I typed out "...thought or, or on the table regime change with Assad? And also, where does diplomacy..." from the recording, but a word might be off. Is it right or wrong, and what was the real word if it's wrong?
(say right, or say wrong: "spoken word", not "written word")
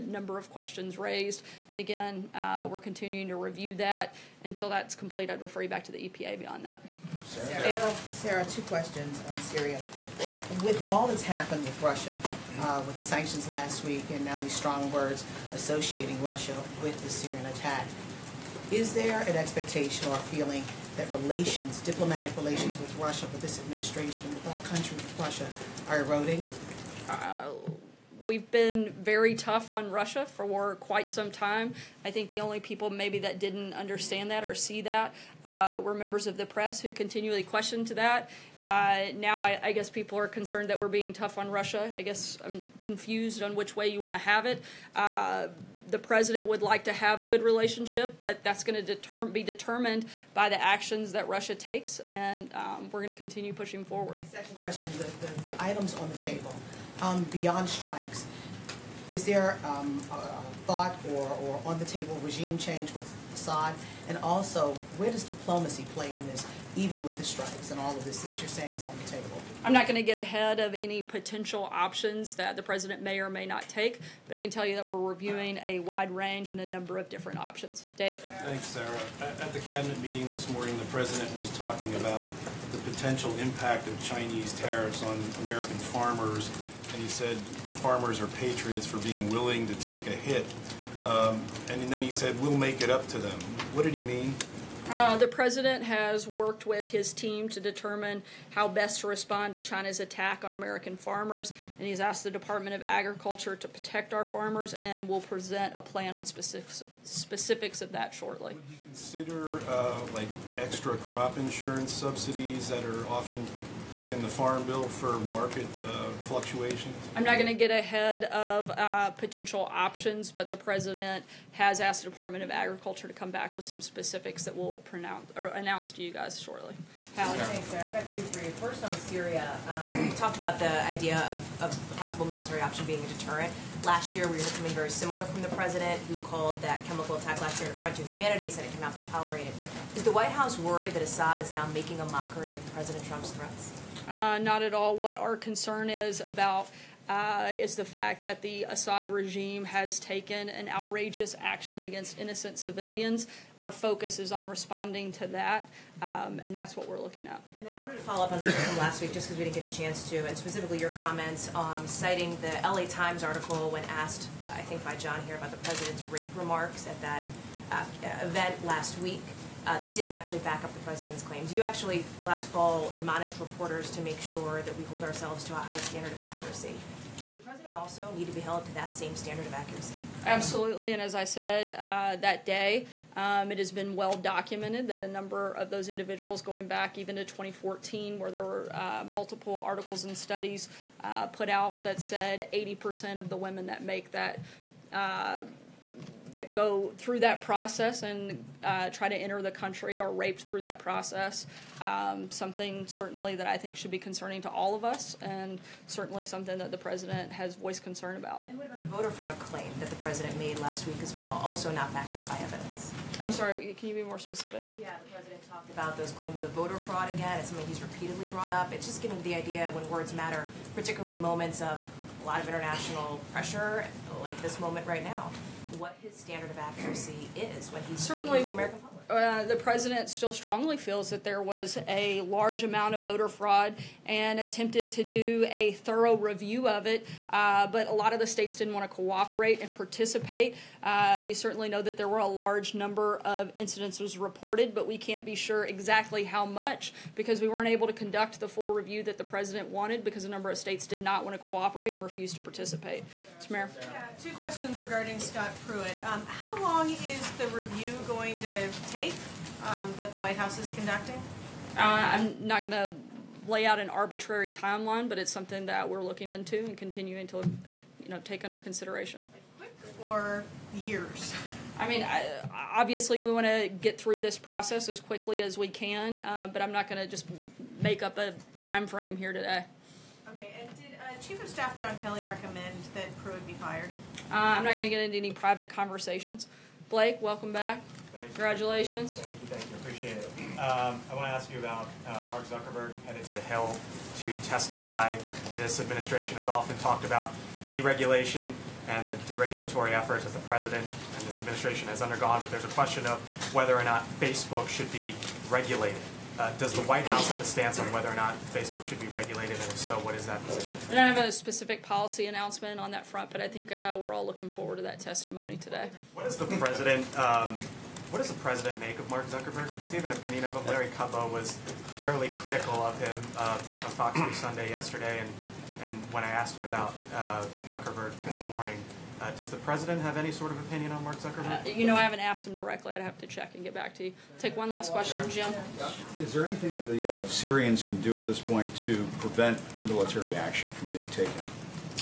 right.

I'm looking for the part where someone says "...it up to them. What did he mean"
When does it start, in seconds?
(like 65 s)
92 s.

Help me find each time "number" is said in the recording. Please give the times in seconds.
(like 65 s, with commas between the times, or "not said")
76 s, 185 s, 242 s, 250 s.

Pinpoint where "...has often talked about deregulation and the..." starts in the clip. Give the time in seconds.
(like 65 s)
296 s.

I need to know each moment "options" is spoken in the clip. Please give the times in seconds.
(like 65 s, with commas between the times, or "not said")
71 s, 77 s, 119 s, 132 s.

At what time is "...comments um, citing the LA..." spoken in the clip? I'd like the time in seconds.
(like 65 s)
160 s.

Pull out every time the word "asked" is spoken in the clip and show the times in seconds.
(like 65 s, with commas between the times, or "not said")
101 s, 121 s, 163 s, 326 s, 332 s.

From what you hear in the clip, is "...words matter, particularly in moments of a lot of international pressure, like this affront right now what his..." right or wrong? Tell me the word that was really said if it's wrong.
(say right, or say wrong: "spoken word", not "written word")
wrong: "moment", not "affront".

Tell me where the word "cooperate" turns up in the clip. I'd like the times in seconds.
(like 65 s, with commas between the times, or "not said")
238 s, 251 s.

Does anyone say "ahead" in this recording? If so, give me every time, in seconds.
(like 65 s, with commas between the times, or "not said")
70 s, 117 s.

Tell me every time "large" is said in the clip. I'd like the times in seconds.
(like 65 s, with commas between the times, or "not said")
232 s, 242 s.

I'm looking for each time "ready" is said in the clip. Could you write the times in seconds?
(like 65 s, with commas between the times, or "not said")
not said.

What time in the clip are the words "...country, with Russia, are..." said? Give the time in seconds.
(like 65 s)
24 s.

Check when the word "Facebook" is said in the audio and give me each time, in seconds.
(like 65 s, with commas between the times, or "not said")
304 s, 308 s.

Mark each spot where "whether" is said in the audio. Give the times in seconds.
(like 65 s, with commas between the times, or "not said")
303 s, 307 s.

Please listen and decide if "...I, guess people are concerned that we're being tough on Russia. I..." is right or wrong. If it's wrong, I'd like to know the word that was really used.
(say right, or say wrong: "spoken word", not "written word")
right.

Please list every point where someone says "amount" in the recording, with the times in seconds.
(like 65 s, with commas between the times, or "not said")
232 s.